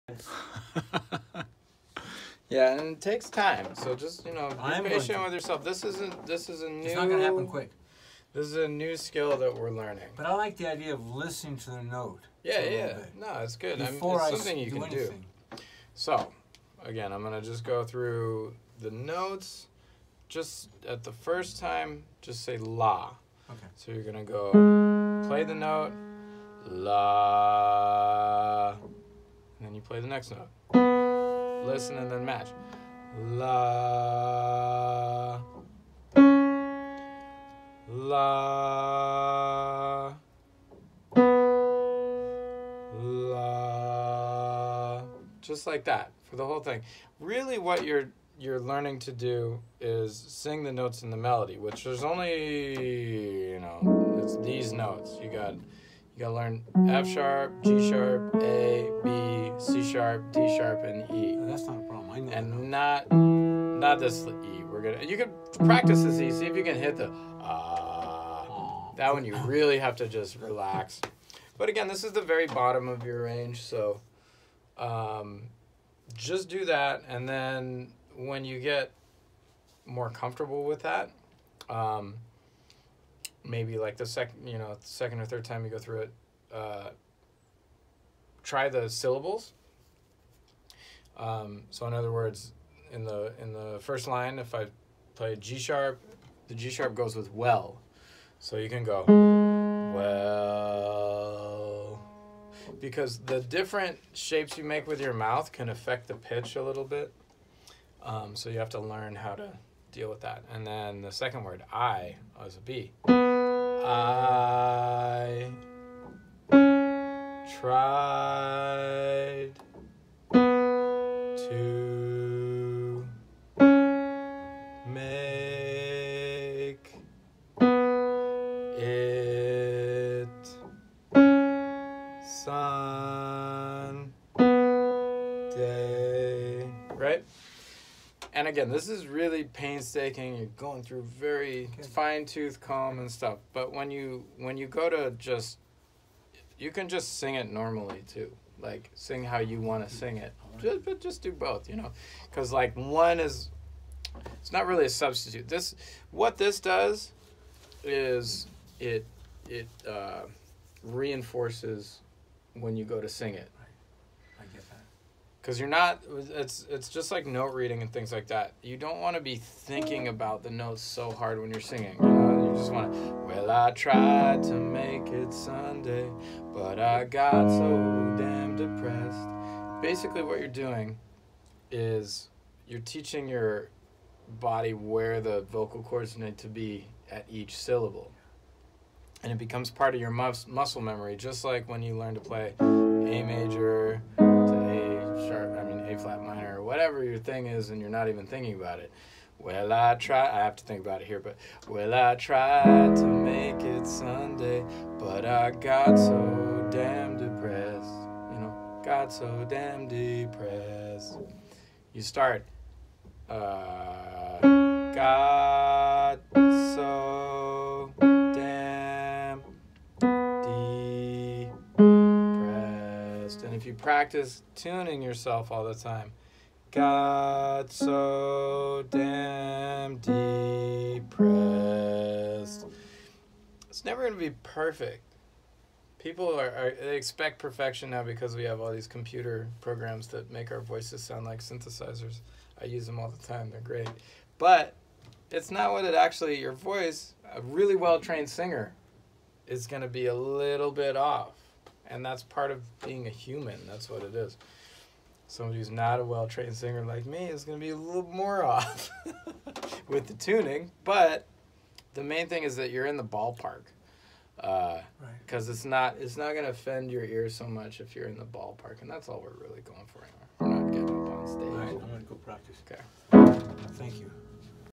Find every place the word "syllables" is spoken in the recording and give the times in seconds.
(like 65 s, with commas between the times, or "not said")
88 s, 187 s.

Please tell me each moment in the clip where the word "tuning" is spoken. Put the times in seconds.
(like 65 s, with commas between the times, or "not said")
224 s, 260 s.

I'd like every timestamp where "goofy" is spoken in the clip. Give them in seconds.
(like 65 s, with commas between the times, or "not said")
not said.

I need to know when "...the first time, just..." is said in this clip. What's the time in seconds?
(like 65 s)
21 s.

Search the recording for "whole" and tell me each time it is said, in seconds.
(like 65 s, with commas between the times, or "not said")
46 s.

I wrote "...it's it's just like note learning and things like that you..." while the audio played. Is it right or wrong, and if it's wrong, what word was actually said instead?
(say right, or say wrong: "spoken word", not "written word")
wrong: "reading", not "learning".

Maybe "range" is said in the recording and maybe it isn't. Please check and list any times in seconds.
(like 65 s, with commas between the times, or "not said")
73 s.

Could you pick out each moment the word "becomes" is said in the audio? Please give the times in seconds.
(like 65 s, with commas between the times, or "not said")
189 s.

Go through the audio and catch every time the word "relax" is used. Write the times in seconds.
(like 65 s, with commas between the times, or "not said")
70 s.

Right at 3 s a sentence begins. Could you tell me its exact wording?
So just you know, be I'm patient with yourself.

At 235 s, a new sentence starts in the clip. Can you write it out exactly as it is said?
People are, are, they expect perfection now because we have all these computer programs that make our voices sound like synthesizers.